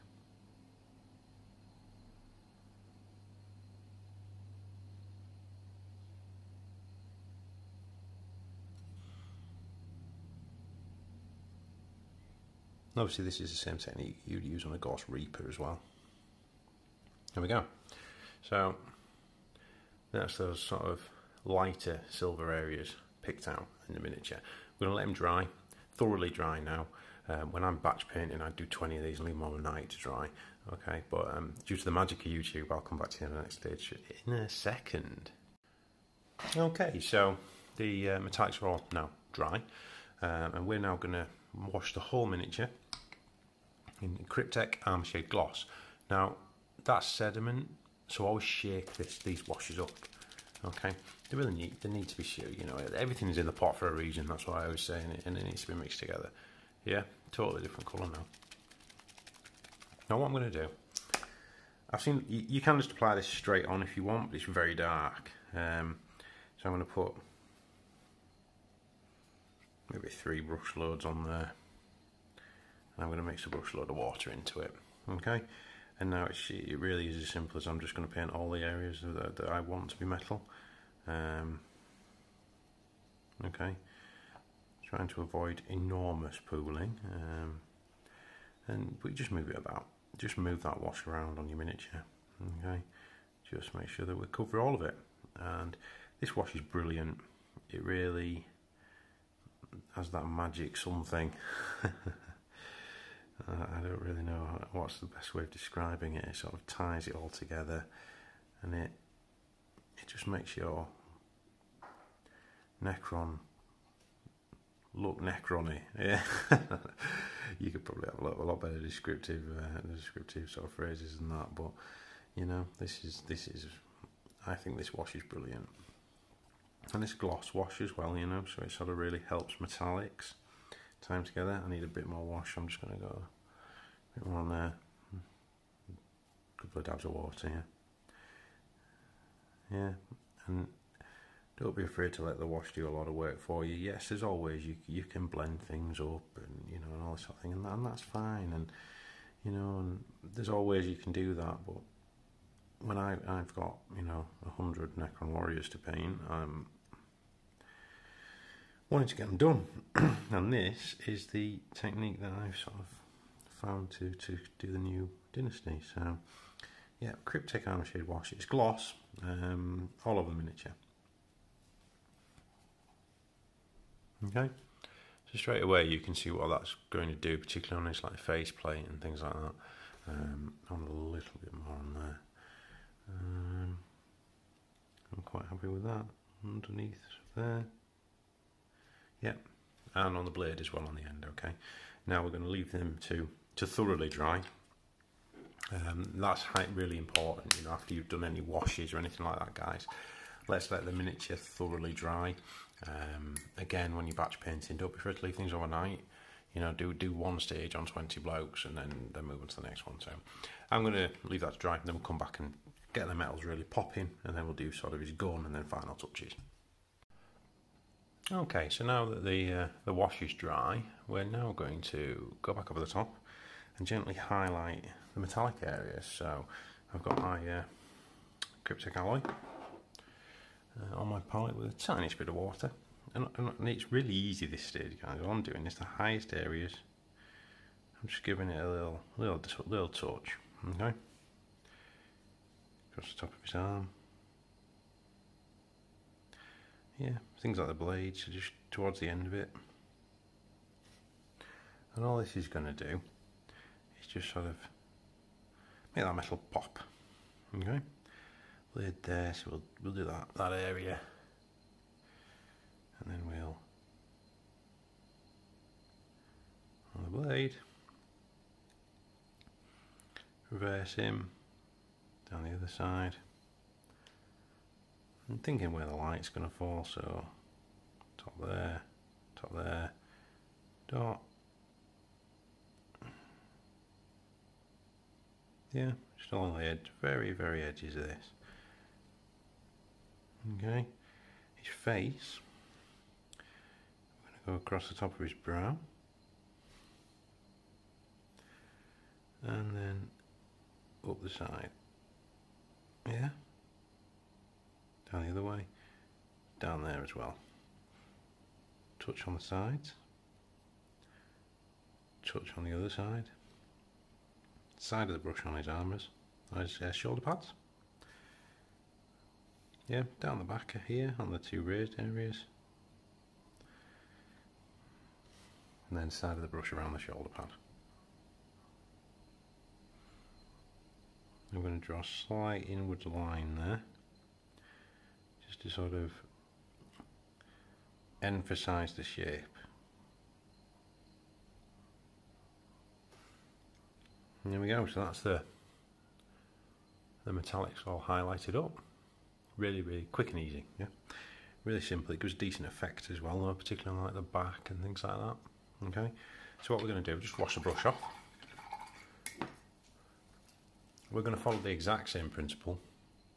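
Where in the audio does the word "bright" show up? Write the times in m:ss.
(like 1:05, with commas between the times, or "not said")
not said.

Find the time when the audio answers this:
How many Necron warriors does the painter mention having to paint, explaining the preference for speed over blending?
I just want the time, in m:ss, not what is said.
2:34.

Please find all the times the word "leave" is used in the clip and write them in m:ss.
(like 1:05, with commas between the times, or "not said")
0:29, 3:12, 3:25, 3:31.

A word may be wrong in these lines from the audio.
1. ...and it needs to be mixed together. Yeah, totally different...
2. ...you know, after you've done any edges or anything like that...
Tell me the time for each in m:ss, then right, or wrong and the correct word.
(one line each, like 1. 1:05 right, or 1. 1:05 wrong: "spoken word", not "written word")
1. 0:55 right
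2. 3:17 wrong: "washes", not "edges".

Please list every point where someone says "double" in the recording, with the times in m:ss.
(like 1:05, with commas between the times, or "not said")
not said.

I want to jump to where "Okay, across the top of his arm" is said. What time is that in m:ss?
4:00.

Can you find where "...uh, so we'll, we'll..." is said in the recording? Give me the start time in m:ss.
4:19.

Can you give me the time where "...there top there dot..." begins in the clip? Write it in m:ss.
4:38.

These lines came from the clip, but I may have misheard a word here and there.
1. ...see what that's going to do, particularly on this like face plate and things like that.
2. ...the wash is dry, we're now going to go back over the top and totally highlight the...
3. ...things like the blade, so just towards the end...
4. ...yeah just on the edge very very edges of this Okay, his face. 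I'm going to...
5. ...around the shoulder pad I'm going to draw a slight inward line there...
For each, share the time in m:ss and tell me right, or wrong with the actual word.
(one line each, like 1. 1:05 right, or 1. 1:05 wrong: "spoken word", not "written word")
1. 2:56 right
2. 3:39 wrong: "gently", not "totally"
3. 4:07 right
4. 4:45 right
5. 5:26 right.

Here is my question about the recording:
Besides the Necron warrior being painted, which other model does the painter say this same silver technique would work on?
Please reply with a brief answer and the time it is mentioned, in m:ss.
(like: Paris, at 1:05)
Gauss Reaper, at 0:14.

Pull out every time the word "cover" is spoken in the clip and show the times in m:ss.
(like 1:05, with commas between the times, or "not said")
1:34.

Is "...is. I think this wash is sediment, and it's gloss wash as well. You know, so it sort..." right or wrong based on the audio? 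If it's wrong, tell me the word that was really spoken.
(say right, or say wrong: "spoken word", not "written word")
wrong: "brilliant", not "sediment".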